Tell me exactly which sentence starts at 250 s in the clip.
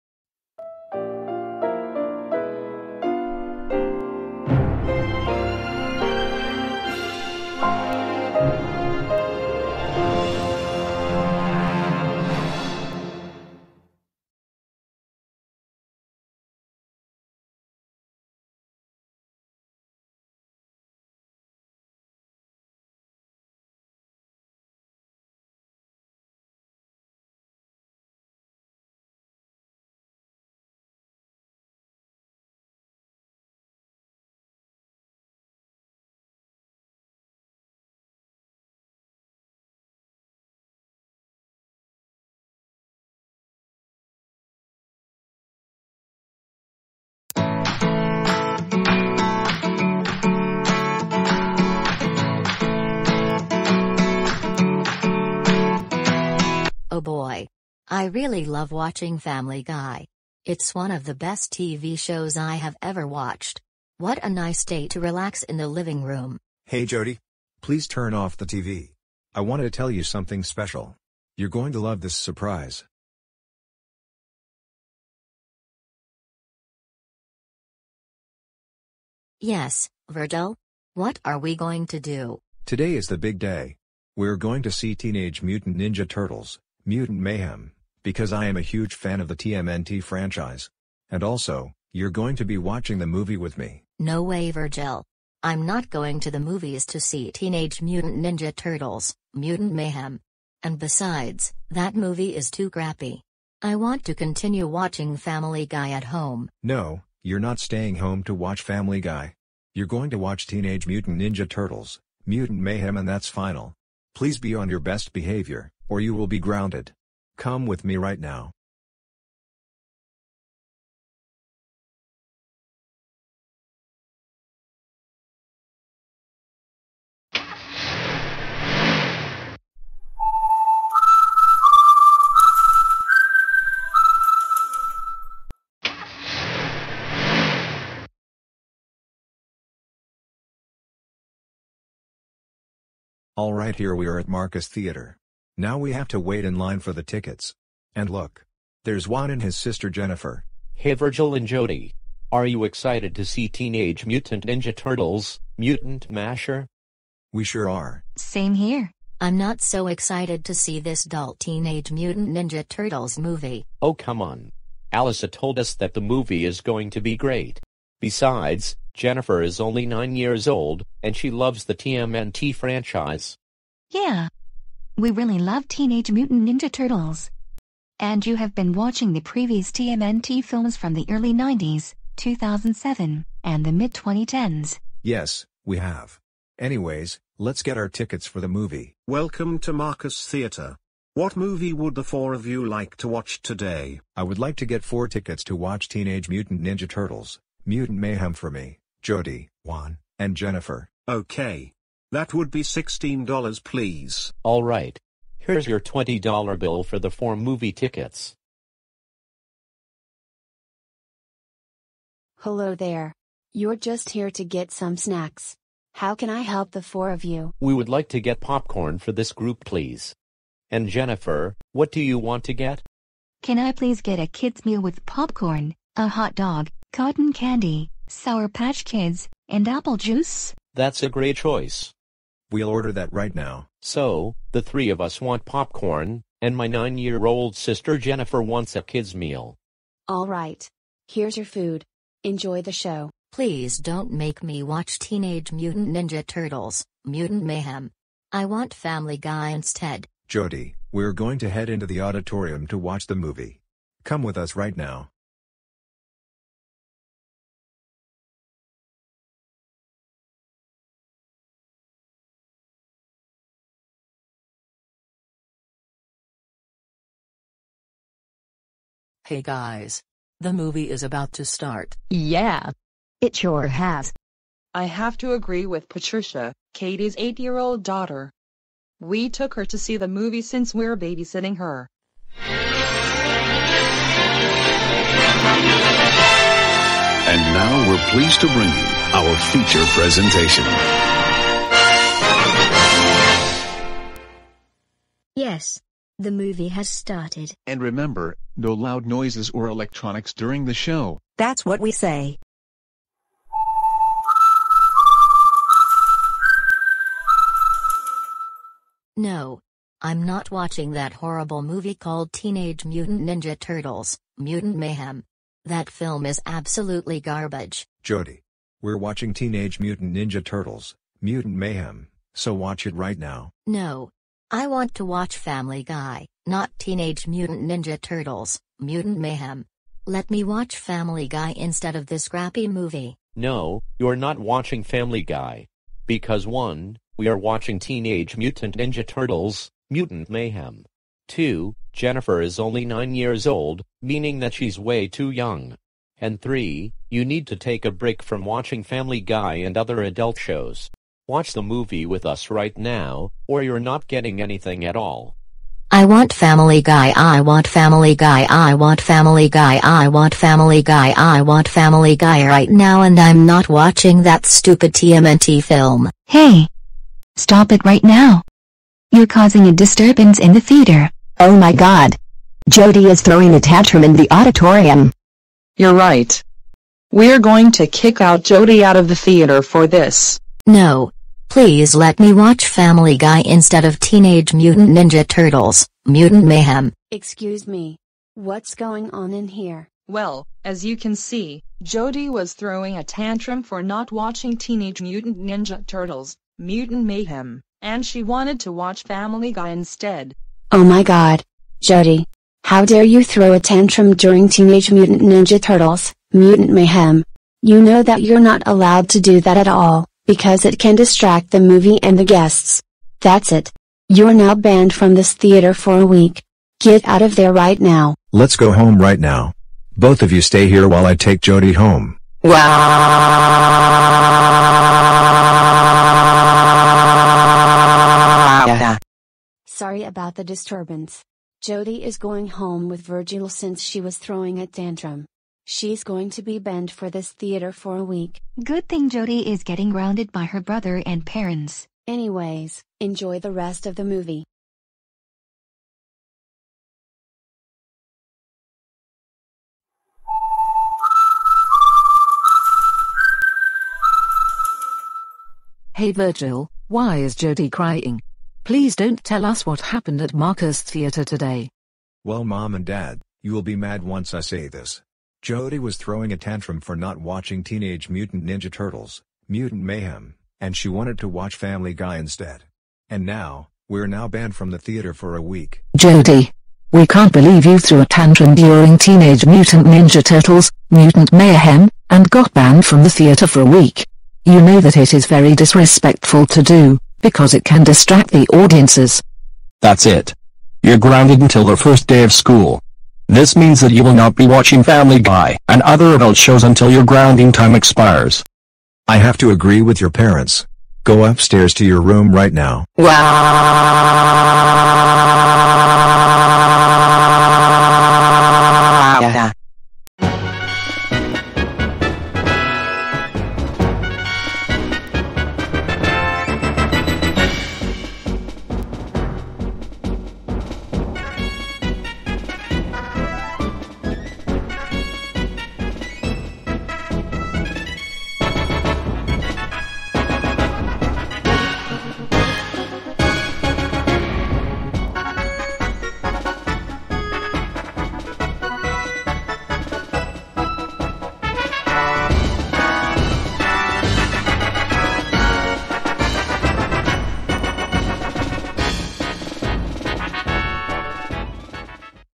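Jodie, we're going to head into the auditorium to watch the movie.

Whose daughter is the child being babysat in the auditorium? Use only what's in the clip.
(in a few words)
Katie.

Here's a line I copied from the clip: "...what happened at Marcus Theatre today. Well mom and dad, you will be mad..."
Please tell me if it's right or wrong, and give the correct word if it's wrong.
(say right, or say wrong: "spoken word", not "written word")
right.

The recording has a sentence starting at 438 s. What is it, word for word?
Good thing Jodie is getting grounded by her brother and parents.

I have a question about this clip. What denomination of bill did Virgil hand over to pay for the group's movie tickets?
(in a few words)
$20.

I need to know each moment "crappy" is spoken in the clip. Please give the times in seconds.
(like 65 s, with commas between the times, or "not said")
102 s, 332 s.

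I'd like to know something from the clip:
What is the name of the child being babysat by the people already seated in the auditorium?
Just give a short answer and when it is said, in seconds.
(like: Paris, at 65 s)
Patricia, at 275 s.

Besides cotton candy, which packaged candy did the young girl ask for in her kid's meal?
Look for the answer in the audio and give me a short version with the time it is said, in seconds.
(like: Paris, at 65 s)
Sour Patch Kids, at 228 s.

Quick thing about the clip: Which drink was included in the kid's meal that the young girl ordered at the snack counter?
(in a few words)
apple juice.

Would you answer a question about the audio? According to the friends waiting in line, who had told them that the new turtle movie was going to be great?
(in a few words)
Alyssa.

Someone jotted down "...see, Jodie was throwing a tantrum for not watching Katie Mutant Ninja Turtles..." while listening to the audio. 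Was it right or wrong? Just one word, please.
wrong.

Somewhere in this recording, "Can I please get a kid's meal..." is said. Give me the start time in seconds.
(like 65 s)
223 s.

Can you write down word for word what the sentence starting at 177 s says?
And you have been watching the previous TMNT films from the early 90s, 2007, and the mid-2010s.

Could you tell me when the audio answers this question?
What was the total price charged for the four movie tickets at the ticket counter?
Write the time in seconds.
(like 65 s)
202 s.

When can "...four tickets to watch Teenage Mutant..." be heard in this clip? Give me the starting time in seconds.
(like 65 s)
194 s.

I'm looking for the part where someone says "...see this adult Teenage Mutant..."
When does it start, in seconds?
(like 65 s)
160 s.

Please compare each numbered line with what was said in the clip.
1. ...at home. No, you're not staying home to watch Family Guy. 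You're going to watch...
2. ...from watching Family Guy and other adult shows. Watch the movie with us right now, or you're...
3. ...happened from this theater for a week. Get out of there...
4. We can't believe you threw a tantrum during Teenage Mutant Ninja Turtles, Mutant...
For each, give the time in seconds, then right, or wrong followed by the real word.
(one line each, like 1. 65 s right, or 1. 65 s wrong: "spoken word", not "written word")
1. 105 s right
2. 348 s right
3. 414 s wrong: "banned", not "happened"
4. 476 s right.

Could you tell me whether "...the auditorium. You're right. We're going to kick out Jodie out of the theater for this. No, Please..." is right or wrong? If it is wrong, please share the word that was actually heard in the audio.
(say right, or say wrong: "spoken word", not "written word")
right.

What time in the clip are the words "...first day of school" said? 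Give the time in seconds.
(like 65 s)
491 s.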